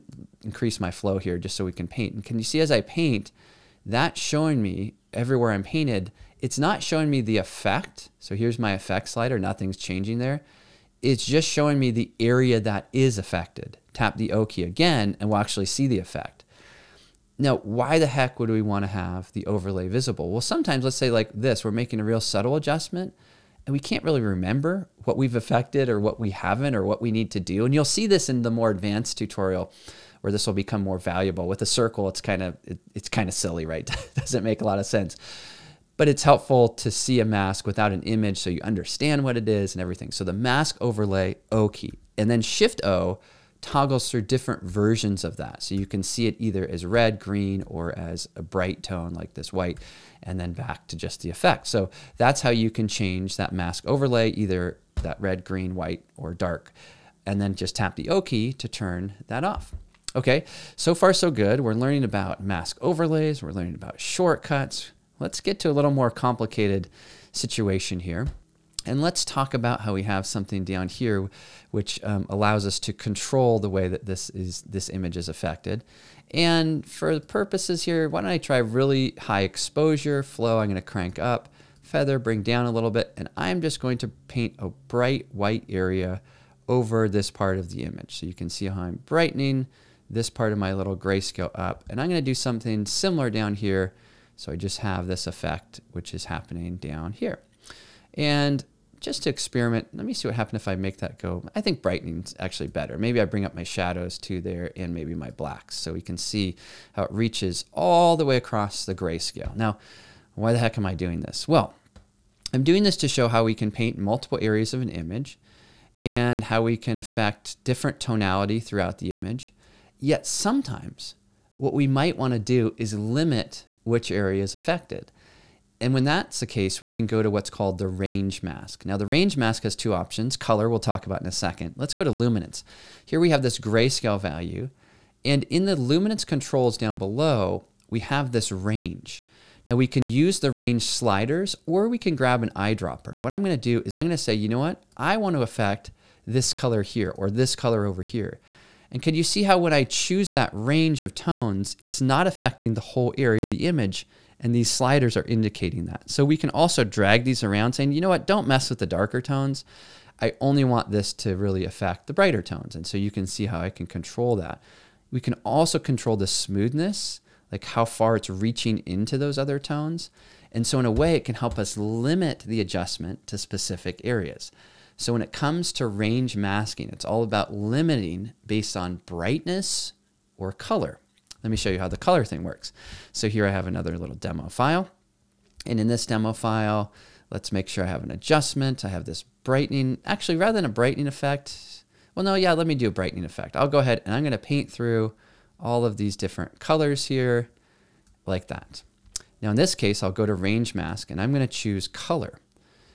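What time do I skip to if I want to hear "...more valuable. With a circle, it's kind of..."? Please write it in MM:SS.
00:30.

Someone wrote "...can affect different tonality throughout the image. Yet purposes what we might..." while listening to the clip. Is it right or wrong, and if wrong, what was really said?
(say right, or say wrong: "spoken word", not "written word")
wrong: "sometimes", not "purposes".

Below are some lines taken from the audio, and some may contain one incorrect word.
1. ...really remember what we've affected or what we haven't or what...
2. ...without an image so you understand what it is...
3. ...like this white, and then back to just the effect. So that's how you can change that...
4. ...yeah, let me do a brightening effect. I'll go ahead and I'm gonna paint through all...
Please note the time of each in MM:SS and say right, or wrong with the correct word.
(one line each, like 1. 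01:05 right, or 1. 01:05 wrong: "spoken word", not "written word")
1. 00:24 right
2. 00:37 right
3. 00:49 right
4. 03:12 right.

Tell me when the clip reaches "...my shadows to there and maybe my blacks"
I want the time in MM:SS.
01:43.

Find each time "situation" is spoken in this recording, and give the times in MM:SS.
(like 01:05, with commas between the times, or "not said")
01:07.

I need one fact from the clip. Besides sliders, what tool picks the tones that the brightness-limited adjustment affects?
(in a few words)
An eyedropper.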